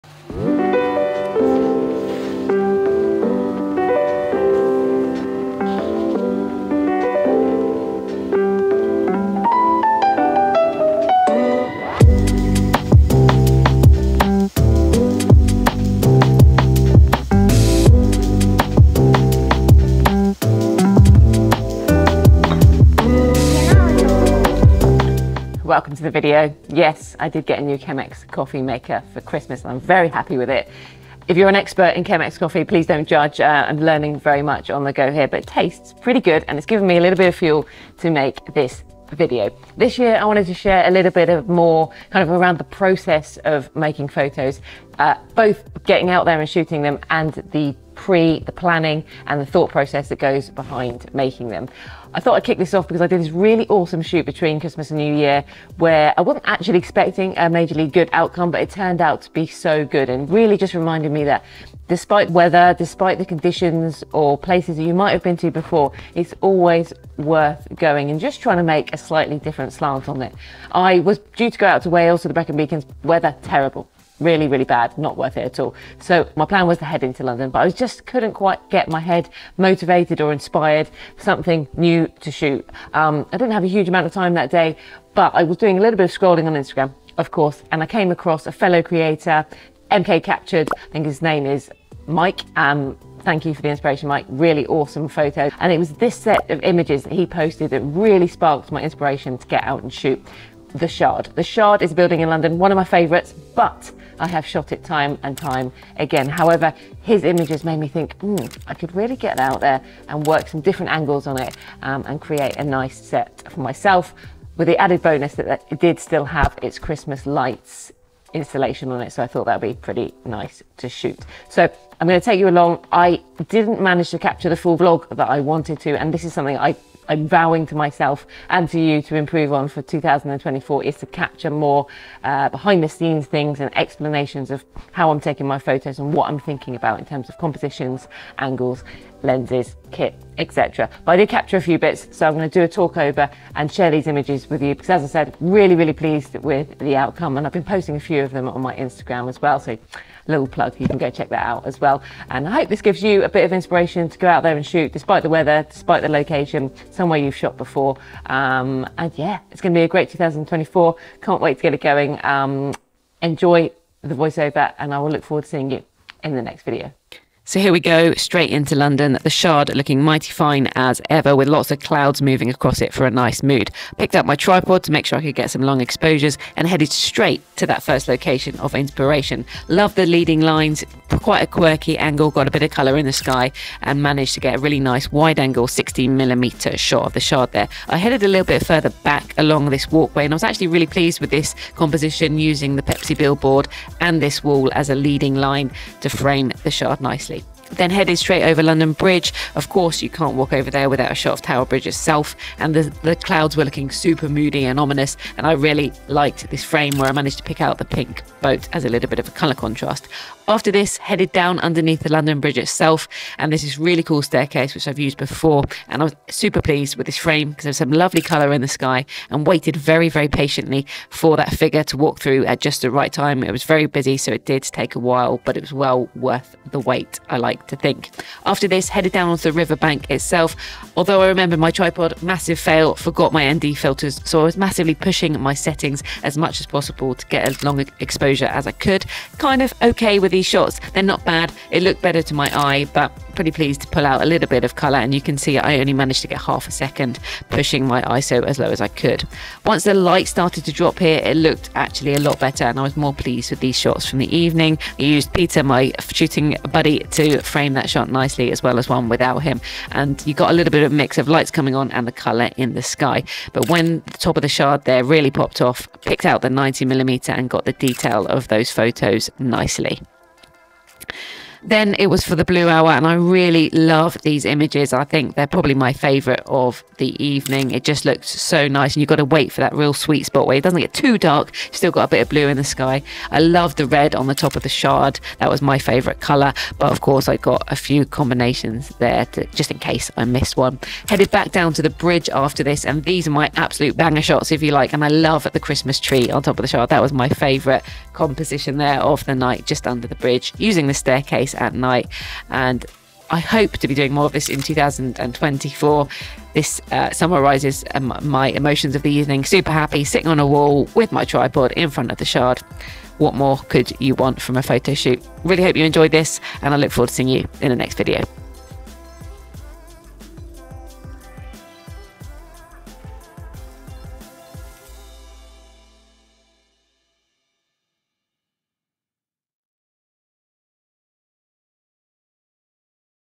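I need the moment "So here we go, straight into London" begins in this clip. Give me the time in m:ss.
2:47.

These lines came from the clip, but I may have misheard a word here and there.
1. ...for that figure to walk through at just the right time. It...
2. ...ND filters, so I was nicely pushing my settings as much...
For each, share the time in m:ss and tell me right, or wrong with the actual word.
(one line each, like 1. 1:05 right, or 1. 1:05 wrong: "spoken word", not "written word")
1. 3:41 right
2. 3:53 wrong: "massively", not "nicely".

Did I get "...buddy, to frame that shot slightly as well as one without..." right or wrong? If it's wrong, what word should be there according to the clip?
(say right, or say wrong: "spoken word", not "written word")
wrong: "nicely", not "slightly".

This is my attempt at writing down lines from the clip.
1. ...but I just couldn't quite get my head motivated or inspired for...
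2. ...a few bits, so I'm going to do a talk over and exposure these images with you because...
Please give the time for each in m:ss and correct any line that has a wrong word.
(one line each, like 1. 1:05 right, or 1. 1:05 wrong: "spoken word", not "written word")
1. 1:17 right
2. 2:21 wrong: "share", not "exposure".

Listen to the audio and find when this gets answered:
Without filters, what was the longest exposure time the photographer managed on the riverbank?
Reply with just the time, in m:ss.
4:06.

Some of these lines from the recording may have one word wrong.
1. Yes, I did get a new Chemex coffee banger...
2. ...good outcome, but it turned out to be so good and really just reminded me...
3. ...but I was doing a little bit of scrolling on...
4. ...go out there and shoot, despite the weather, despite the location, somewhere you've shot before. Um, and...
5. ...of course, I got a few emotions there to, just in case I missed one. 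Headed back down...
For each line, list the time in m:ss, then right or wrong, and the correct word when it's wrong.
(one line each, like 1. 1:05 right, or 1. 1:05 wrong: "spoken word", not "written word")
1. 0:26 wrong: "maker", not "banger"
2. 0:57 right
3. 1:25 right
4. 2:34 right
5. 4:46 wrong: "combinations", not "emotions".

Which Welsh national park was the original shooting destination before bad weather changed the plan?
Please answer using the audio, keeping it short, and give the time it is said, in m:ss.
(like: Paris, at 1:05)
Brecon Beacons, at 1:12.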